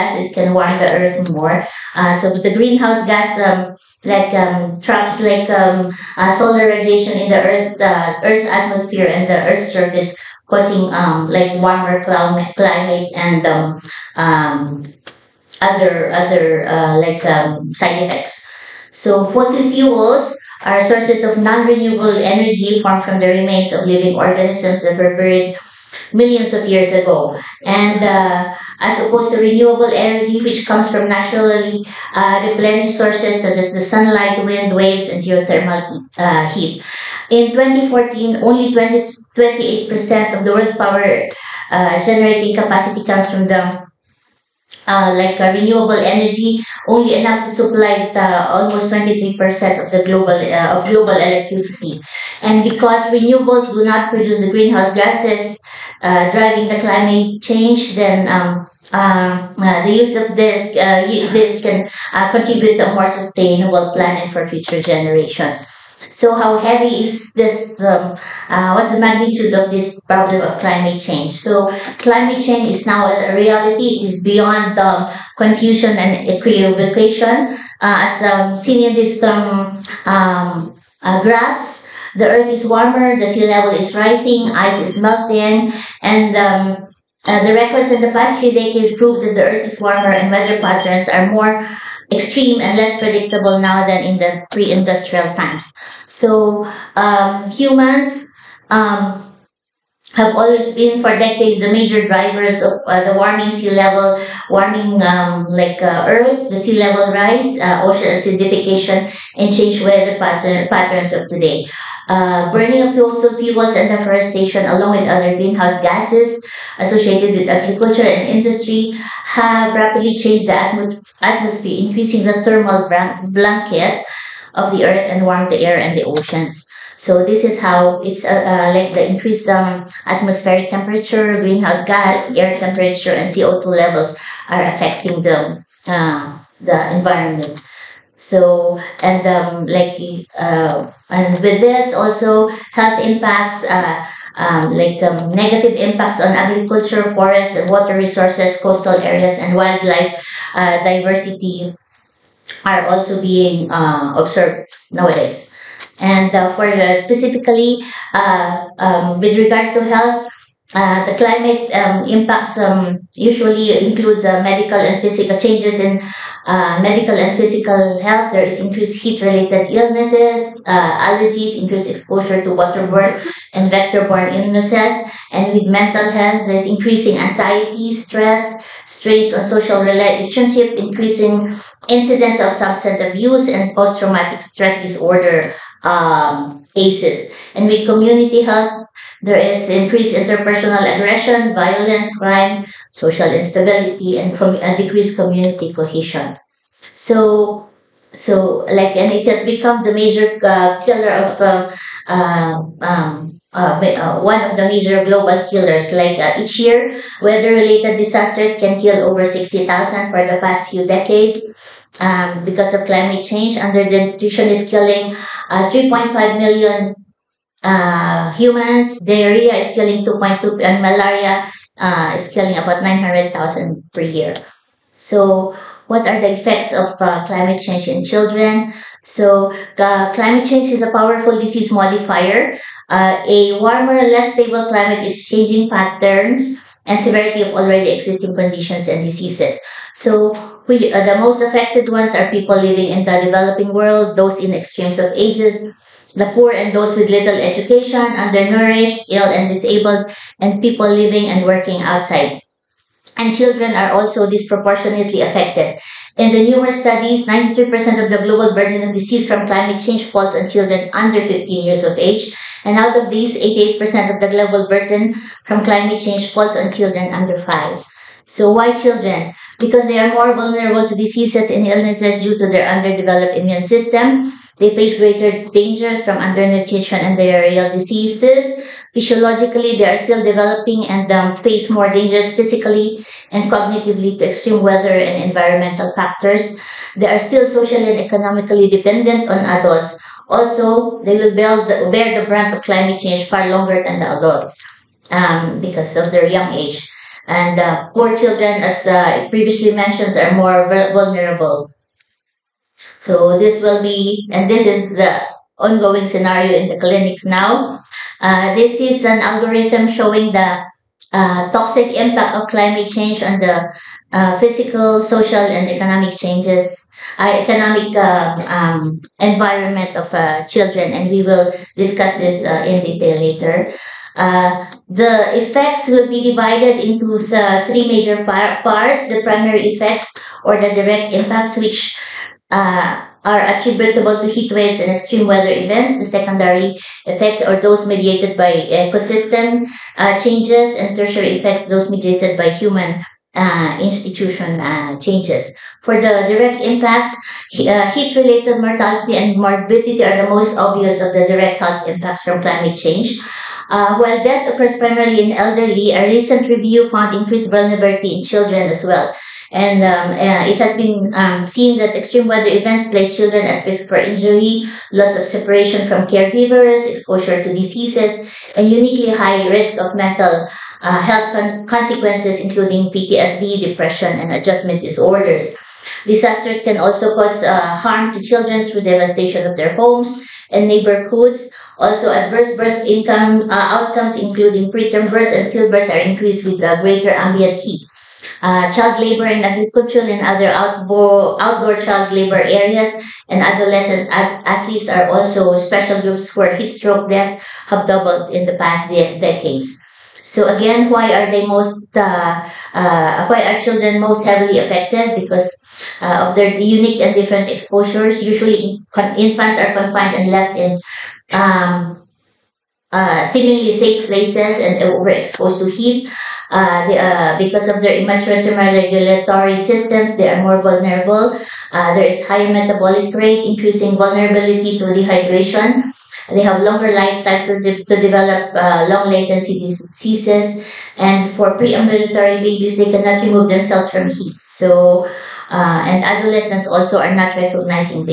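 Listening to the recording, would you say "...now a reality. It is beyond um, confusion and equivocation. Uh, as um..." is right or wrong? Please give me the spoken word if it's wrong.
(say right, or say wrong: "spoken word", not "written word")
right.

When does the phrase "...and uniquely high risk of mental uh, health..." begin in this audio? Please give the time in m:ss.
6:08.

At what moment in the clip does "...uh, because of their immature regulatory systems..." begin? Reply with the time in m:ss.
6:56.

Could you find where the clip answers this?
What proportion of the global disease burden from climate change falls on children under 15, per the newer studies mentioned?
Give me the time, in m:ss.
4:17.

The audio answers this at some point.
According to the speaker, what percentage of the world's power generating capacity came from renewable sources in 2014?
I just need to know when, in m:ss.
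0:38.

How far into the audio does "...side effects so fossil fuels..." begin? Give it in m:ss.
0:17.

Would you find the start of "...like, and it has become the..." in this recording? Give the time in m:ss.
3:18.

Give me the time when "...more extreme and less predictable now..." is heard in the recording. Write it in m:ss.
1:31.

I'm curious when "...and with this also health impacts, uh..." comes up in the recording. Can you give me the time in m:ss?
2:21.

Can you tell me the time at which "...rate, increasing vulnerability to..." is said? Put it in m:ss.
7:03.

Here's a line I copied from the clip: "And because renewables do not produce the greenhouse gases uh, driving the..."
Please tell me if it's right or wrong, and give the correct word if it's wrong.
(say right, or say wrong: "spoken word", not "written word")
right.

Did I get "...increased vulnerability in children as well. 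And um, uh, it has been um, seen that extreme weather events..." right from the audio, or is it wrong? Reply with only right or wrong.
right.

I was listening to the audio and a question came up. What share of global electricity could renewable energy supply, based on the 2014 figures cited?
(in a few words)
almost 23%.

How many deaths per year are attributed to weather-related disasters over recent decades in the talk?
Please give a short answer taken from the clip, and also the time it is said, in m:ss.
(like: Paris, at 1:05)
over 60,000, at 3:29.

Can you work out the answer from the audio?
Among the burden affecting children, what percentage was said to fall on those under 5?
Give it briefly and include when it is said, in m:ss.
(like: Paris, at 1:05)
88%, at 4:23.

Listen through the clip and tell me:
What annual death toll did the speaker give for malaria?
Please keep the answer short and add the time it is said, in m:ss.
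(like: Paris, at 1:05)
900,000, at 3:42.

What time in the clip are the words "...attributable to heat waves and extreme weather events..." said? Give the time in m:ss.
5:33.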